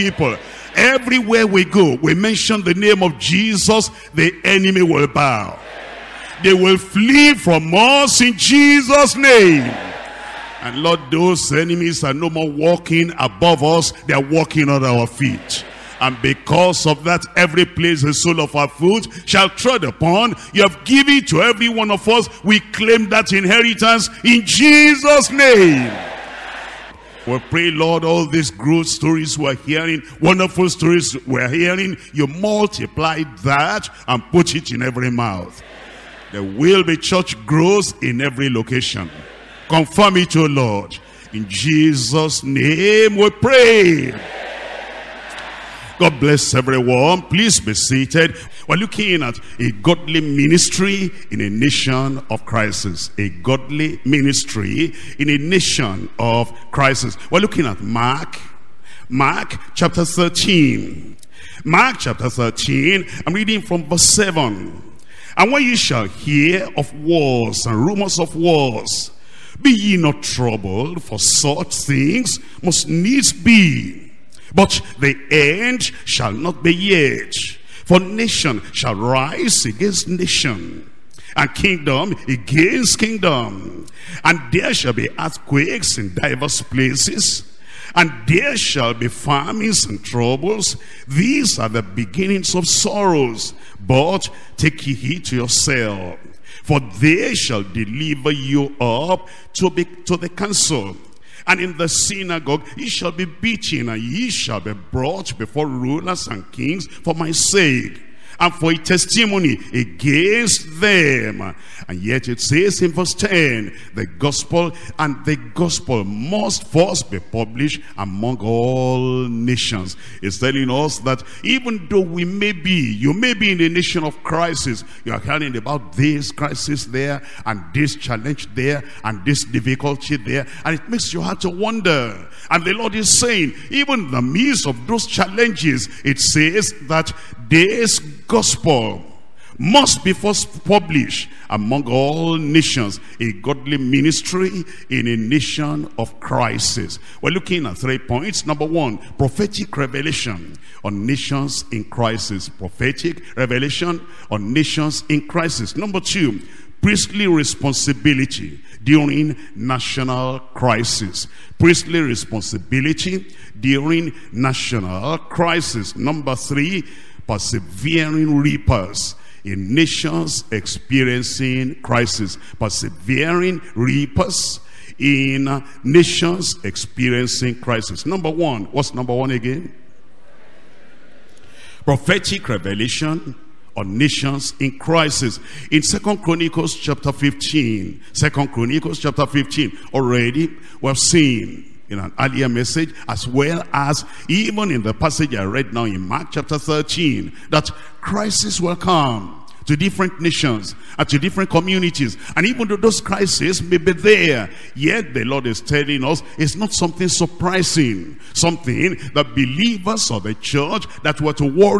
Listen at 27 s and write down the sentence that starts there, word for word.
We pray, Lord, all these growth stories we're hearing, wonderful stories we're hearing, you multiply that and put it in every mouth.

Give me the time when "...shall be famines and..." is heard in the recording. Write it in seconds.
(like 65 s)
88 s.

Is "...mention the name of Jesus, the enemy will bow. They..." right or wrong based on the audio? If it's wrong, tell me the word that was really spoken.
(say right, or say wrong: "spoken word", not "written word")
right.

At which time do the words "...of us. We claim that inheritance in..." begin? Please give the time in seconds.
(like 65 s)
21 s.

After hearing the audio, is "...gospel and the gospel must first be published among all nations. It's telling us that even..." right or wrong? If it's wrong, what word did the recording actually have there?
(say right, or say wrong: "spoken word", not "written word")
right.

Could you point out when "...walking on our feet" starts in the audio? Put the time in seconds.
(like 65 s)
14 s.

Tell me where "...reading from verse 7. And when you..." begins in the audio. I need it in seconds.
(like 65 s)
63 s.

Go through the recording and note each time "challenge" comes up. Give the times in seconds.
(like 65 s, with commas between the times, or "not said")
127 s, 135 s.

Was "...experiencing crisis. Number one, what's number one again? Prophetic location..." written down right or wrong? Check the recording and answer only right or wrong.
wrong.